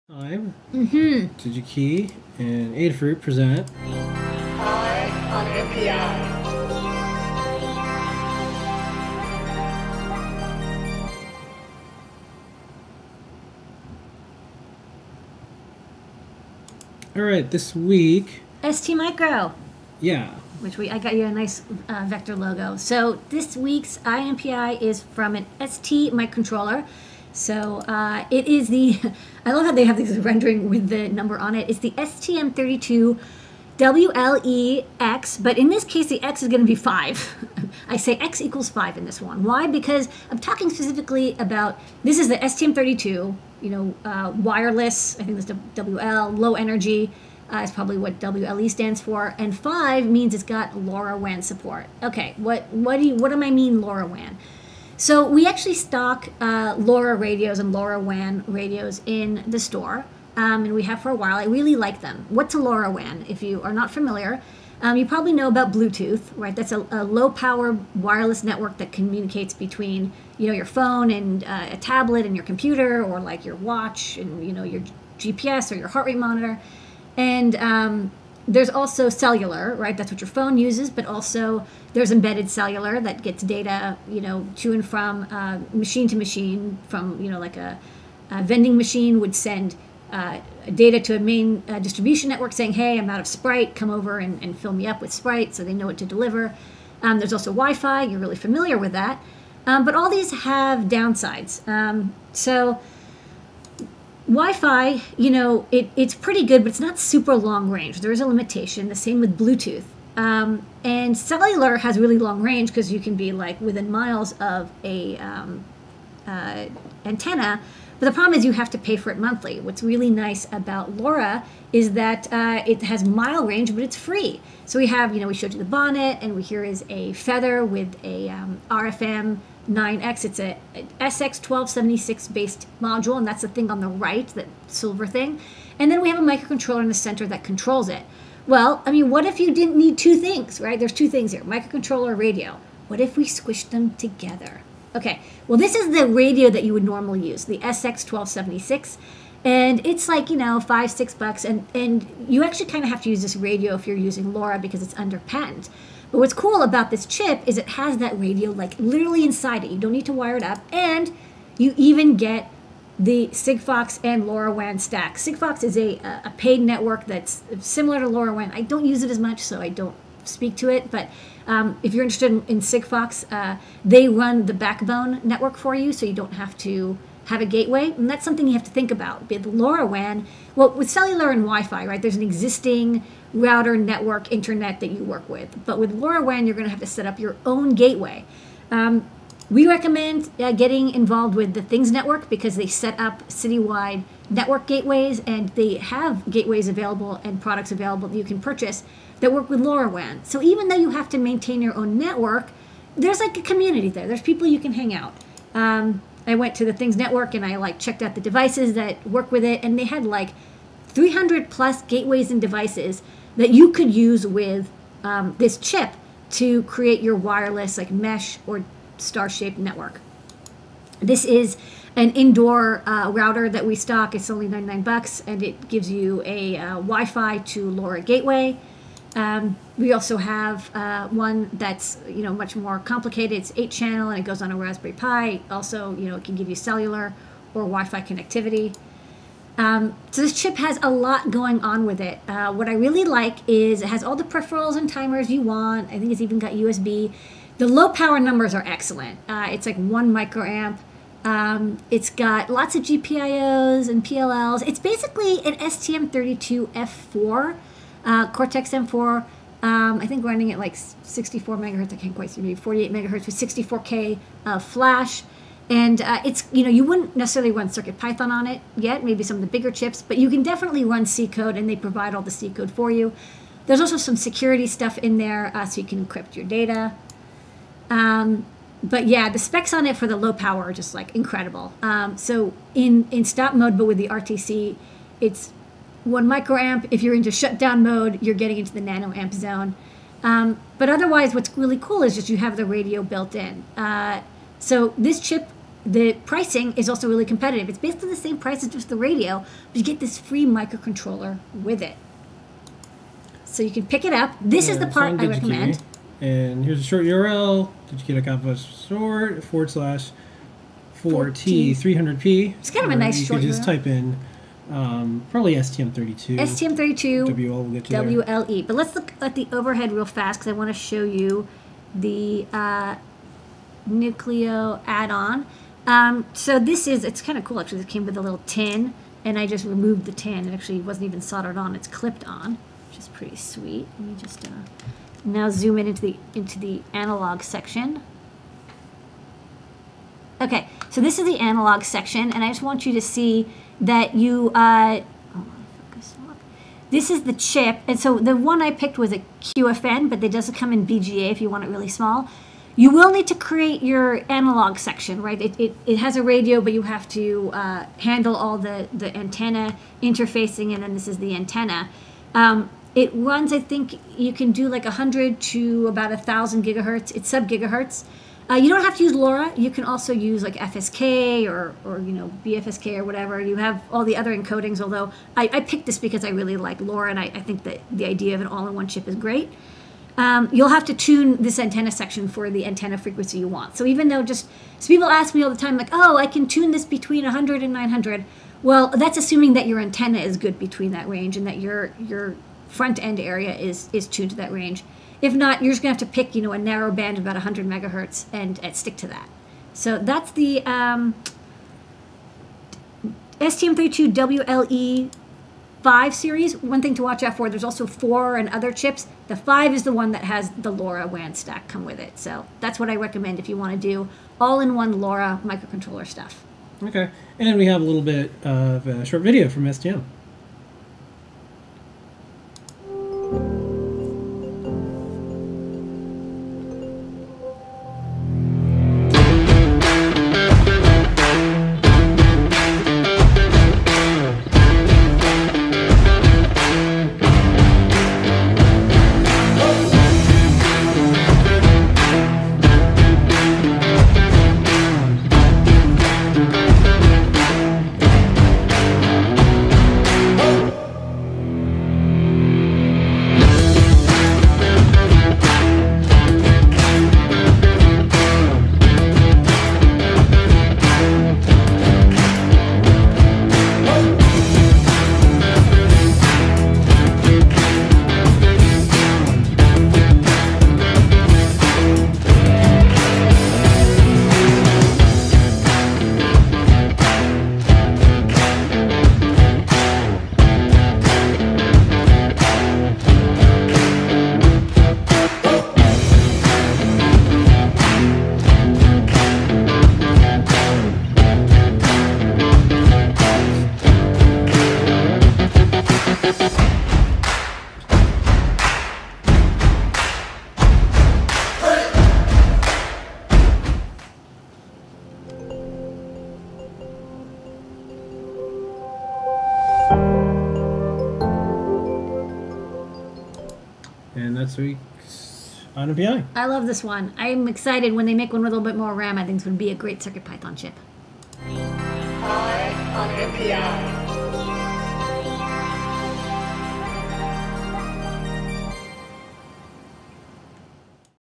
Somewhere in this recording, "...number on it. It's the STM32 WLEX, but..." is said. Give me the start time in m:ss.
0:31.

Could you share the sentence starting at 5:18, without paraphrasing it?
But let's look at the overhead real fast because I want to show you the uh, Nucleo add-on.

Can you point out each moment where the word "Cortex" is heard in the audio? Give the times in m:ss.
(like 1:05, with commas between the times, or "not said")
4:18.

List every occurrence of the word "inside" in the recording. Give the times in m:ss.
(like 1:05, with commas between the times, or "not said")
2:39.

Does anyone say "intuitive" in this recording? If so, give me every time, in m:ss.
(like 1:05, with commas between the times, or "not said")
not said.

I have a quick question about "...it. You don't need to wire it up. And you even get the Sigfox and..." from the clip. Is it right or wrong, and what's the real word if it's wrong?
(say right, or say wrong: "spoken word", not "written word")
right.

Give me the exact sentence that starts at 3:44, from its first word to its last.
It's only 99 bucks, and it gives you a uh, Wi-Fi to LoRa gateway.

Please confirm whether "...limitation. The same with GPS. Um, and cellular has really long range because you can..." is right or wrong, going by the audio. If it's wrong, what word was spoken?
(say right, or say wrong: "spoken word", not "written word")
wrong: "Bluetooth", not "GPS".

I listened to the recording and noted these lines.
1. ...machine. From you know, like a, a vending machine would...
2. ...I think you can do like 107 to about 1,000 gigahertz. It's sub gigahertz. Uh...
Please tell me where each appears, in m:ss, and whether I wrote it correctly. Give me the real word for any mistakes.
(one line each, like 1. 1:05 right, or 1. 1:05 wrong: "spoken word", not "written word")
1. 1:26 right
2. 6:03 wrong: "100", not "107".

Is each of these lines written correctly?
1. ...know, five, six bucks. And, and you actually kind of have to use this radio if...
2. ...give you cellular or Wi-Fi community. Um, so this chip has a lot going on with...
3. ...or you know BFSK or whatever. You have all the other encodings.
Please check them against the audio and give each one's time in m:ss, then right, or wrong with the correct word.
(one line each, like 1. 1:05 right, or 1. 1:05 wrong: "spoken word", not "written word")
1. 2:30 right
2. 3:56 wrong: "connectivity", not "community"
3. 6:11 right.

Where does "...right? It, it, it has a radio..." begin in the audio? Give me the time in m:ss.
5:55.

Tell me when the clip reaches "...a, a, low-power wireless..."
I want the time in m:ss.
1:06.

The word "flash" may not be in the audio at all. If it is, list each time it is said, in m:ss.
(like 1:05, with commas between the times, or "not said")
4:24.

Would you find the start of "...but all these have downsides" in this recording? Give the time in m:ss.
1:39.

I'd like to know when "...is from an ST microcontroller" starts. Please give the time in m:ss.
0:24.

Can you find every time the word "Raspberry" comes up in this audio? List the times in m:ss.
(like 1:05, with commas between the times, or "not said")
3:54.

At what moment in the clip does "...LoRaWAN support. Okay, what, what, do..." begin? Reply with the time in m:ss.
0:50.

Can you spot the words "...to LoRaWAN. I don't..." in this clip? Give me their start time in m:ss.
2:47.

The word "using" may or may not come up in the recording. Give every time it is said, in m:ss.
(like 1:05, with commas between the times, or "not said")
2:33.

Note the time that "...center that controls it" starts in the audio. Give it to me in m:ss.
2:16.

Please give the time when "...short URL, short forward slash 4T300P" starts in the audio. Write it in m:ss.
5:06.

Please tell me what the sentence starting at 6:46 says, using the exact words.
One thing to watch out for, there's also 4 and other chips.